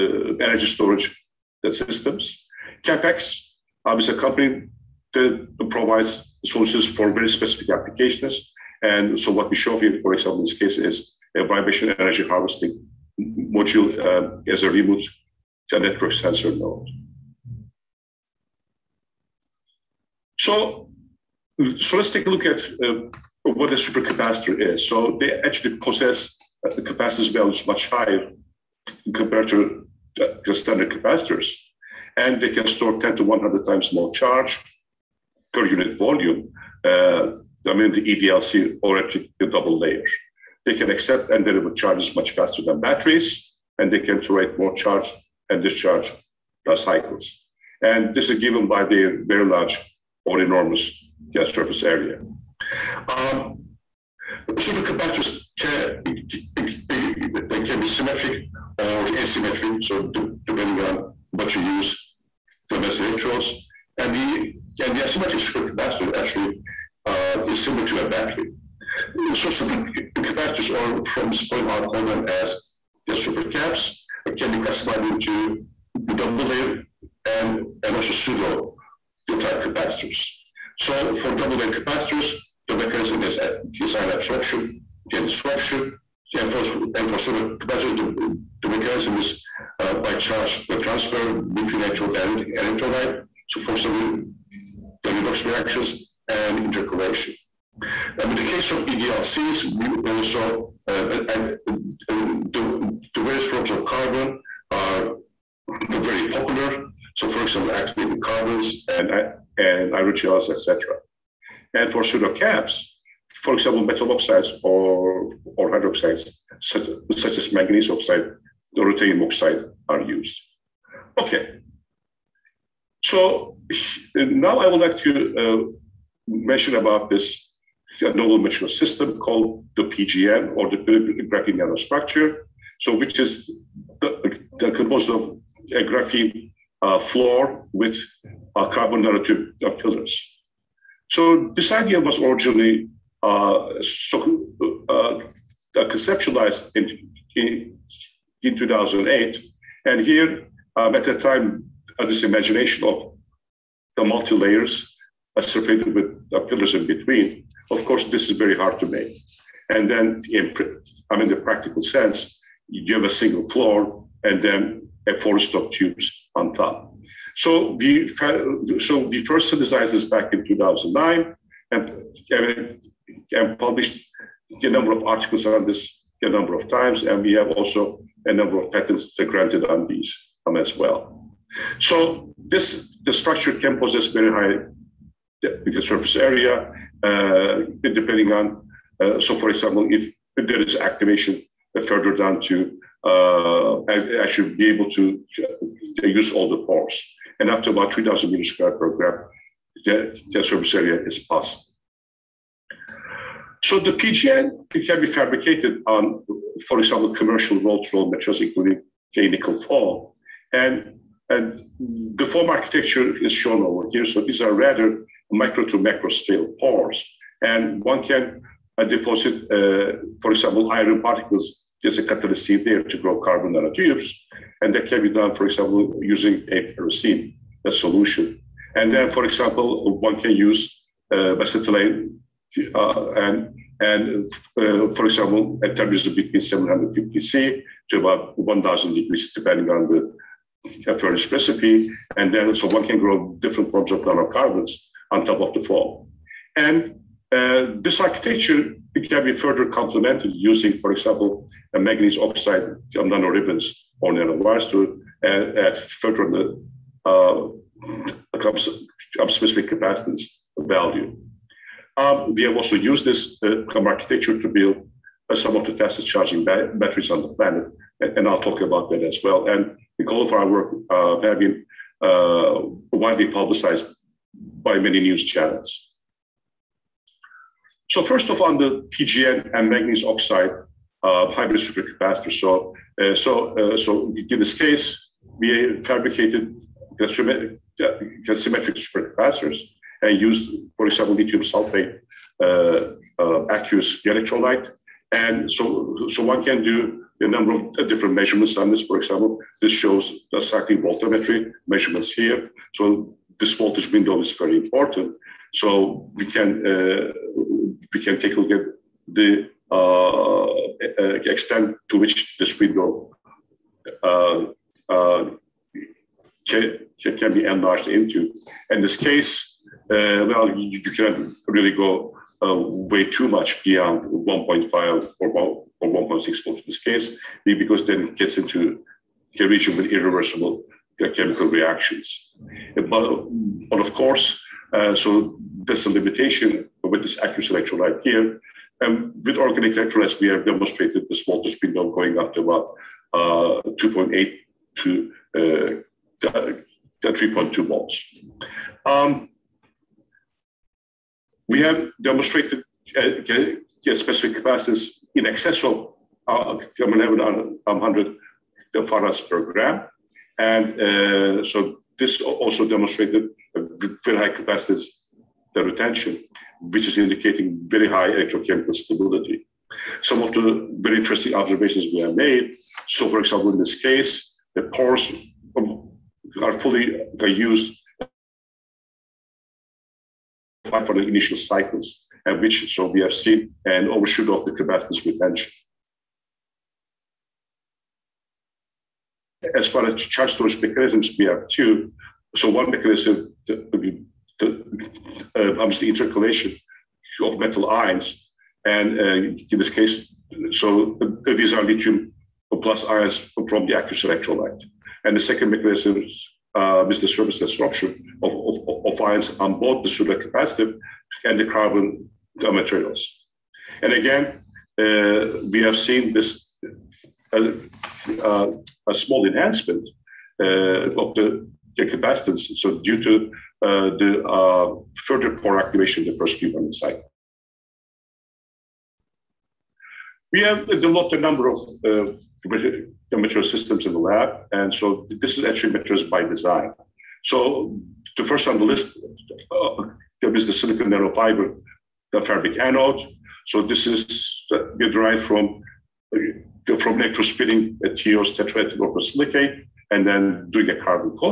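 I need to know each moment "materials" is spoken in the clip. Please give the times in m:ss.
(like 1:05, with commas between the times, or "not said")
2:08, 3:28, 6:52.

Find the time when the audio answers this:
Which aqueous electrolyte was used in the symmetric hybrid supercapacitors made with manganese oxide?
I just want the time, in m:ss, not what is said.
4:51.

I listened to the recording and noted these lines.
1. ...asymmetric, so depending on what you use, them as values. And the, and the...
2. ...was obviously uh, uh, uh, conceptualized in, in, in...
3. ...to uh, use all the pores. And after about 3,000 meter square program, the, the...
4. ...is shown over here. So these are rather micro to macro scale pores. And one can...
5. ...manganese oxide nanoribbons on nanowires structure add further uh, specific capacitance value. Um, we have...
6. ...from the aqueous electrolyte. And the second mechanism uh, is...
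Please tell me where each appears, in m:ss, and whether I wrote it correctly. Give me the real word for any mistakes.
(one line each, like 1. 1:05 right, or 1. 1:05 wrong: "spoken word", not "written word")
1. 0:59 wrong: "electrodes", not "values"
2. 2:21 wrong: "originally", not "obviously"
3. 3:14 right
4. 3:33 right
5. 4:11 right
6. 6:43 right.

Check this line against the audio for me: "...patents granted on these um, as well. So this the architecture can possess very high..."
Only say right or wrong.
wrong.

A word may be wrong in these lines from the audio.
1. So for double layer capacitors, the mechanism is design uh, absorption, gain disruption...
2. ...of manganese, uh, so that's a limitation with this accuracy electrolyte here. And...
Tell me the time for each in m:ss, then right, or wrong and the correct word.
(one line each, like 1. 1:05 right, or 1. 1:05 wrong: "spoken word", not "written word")
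1. 1:20 right
2. 5:33 wrong: "course", not "manganese".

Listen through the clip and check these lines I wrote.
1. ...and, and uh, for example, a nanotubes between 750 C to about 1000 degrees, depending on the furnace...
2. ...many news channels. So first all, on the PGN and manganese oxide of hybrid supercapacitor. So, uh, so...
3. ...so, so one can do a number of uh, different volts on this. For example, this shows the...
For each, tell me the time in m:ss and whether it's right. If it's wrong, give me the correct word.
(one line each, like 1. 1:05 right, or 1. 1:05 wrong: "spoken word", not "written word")
1. 3:53 wrong: "temperatures", not "nanotubes"
2. 4:34 right
3. 4:55 wrong: "measurements", not "volts".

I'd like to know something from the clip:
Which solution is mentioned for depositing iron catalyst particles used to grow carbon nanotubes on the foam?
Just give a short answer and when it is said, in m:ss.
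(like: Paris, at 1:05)
ferrocene, at 3:46.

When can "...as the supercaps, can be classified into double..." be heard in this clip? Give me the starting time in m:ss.
1:12.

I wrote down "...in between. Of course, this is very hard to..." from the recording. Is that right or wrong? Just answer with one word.
right.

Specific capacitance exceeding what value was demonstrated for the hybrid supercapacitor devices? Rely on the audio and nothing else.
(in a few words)
100 farads per gram.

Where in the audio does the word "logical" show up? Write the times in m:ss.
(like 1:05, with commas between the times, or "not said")
not said.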